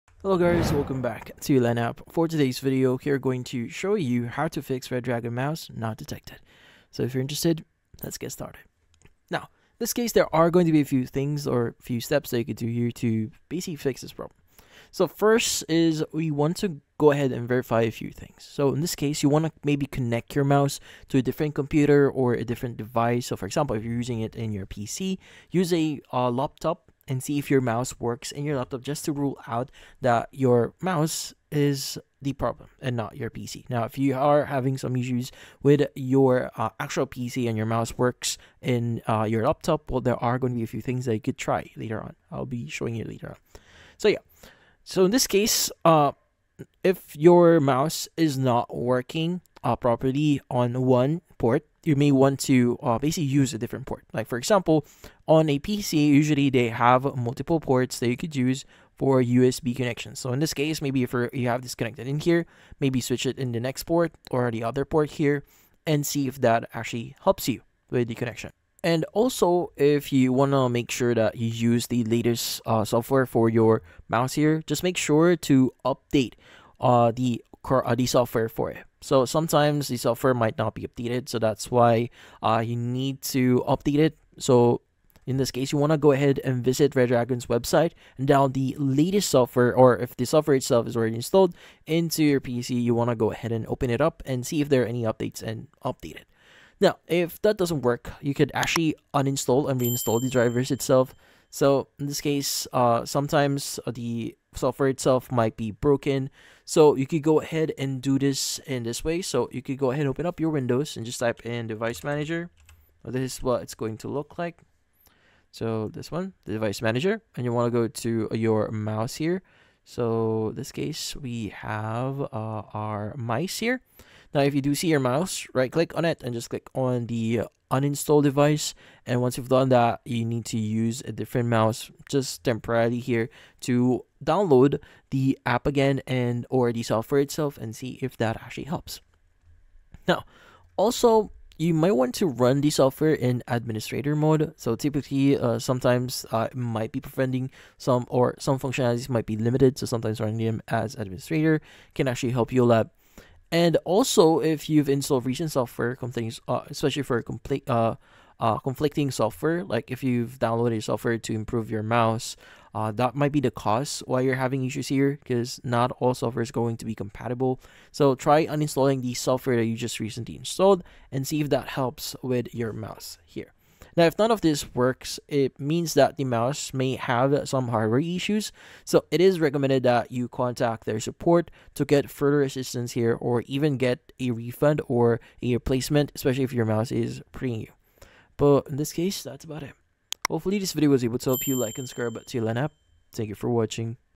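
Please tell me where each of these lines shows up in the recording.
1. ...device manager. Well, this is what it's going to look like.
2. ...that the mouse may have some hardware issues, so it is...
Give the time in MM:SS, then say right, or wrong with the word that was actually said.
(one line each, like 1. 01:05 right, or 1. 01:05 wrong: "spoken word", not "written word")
1. 01:51 right
2. 02:55 right.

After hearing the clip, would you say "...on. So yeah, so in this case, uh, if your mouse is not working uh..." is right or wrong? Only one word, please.
right.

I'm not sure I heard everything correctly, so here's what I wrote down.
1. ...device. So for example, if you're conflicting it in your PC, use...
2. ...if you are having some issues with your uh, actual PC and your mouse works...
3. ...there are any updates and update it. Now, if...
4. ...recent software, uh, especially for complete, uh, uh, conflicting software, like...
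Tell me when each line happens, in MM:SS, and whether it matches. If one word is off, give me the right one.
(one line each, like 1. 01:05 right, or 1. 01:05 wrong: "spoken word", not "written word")
1. 00:22 wrong: "using", not "conflicting"
2. 00:33 right
3. 01:34 right
4. 02:35 right.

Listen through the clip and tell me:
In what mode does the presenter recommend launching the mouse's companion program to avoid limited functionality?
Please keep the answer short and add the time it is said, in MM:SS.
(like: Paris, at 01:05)
administrator mode, at 02:23.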